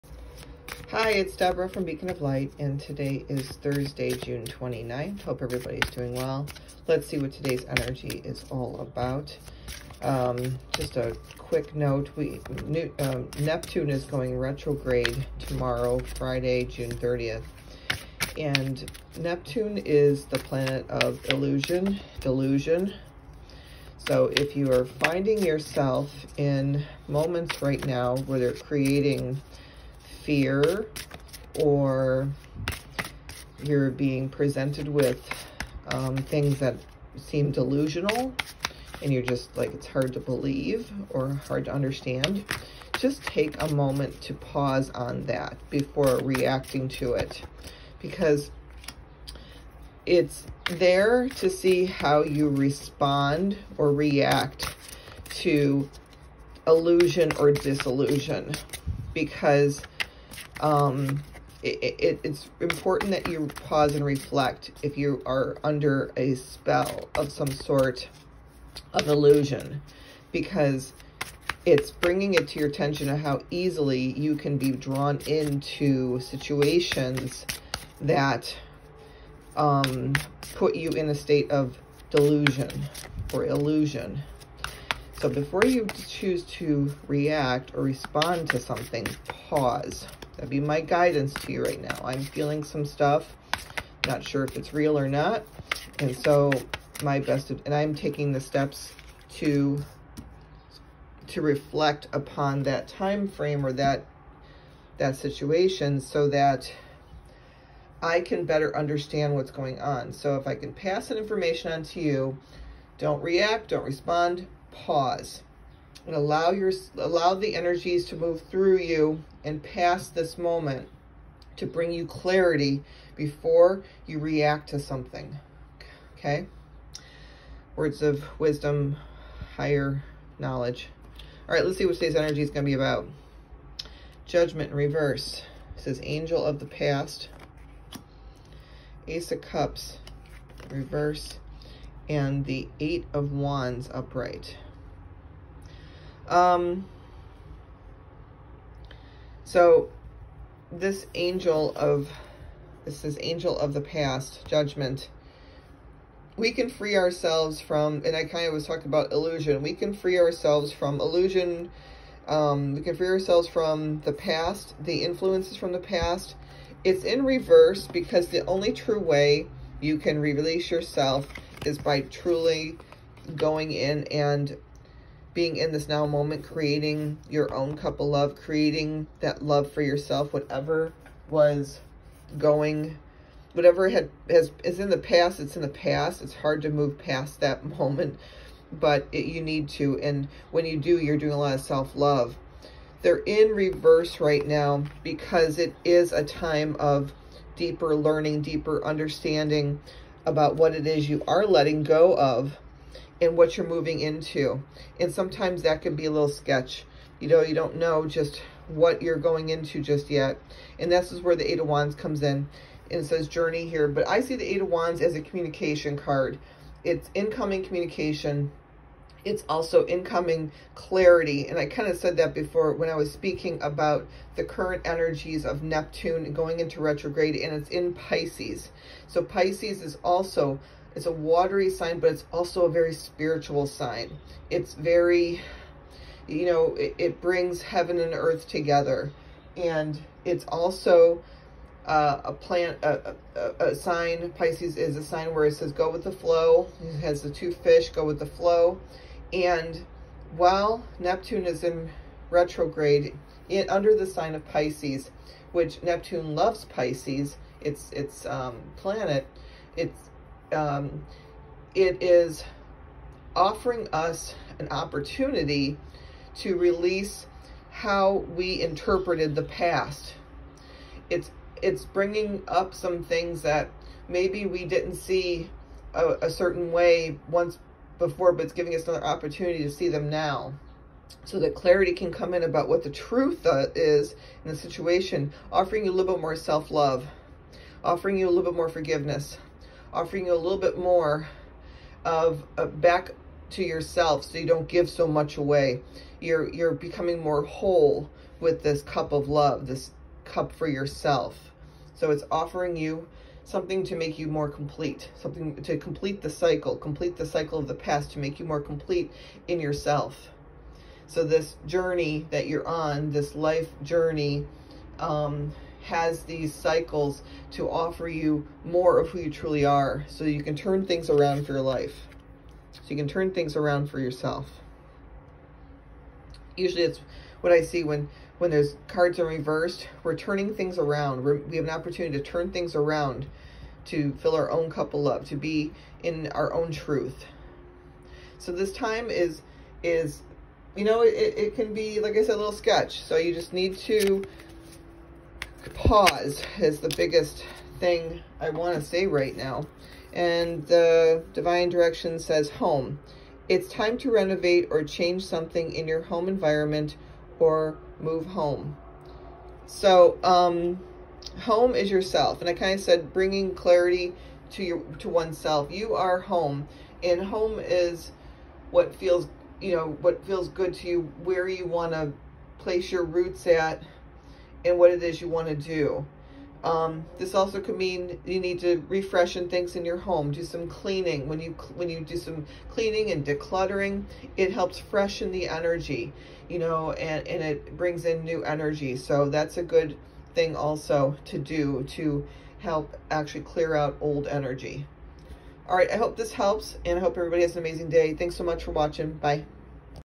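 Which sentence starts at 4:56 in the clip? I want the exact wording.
You're, you're becoming more whole with this cup of love, this cup for yourself.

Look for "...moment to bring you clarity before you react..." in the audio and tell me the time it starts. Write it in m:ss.
2:00.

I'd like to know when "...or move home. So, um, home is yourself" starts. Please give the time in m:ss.
5:57.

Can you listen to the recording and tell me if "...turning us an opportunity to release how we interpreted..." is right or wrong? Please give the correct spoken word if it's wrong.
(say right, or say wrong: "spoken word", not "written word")
wrong: "offering", not "turning".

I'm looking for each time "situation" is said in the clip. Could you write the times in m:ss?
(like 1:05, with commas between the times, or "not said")
1:16, 1:45, 4:44.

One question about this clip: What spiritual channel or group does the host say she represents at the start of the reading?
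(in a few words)
Beacon of Light.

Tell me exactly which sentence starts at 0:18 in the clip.
And Neptune is the planet of illusion, delusion.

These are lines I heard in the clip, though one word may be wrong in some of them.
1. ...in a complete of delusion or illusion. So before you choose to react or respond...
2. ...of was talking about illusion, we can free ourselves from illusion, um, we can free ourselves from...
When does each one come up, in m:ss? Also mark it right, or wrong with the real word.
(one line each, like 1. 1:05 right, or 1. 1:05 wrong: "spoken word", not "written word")
1. 1:20 wrong: "state", not "complete"
2. 2:38 right.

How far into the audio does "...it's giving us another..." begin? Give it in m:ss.
4:38.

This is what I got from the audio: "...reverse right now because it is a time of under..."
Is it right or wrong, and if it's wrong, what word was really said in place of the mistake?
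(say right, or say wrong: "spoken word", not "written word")
wrong: "deeper", not "under".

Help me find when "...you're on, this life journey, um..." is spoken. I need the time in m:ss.
5:12.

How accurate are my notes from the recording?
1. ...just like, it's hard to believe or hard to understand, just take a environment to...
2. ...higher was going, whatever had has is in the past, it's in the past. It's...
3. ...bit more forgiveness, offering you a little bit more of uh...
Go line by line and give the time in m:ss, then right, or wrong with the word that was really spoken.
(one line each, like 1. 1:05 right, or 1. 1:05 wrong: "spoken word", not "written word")
1. 0:39 wrong: "moment", not "environment"
2. 3:00 wrong: "whatever", not "higher"
3. 4:48 right.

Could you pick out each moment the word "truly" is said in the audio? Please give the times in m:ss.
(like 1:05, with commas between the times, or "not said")
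2:52, 5:19.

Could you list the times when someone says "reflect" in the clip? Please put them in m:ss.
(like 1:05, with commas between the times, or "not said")
1:04, 1:41.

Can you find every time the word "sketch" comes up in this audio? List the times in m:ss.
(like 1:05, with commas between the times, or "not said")
3:26, 5:42.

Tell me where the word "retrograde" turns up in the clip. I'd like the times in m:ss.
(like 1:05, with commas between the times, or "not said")
0:14, 3:46, 4:12.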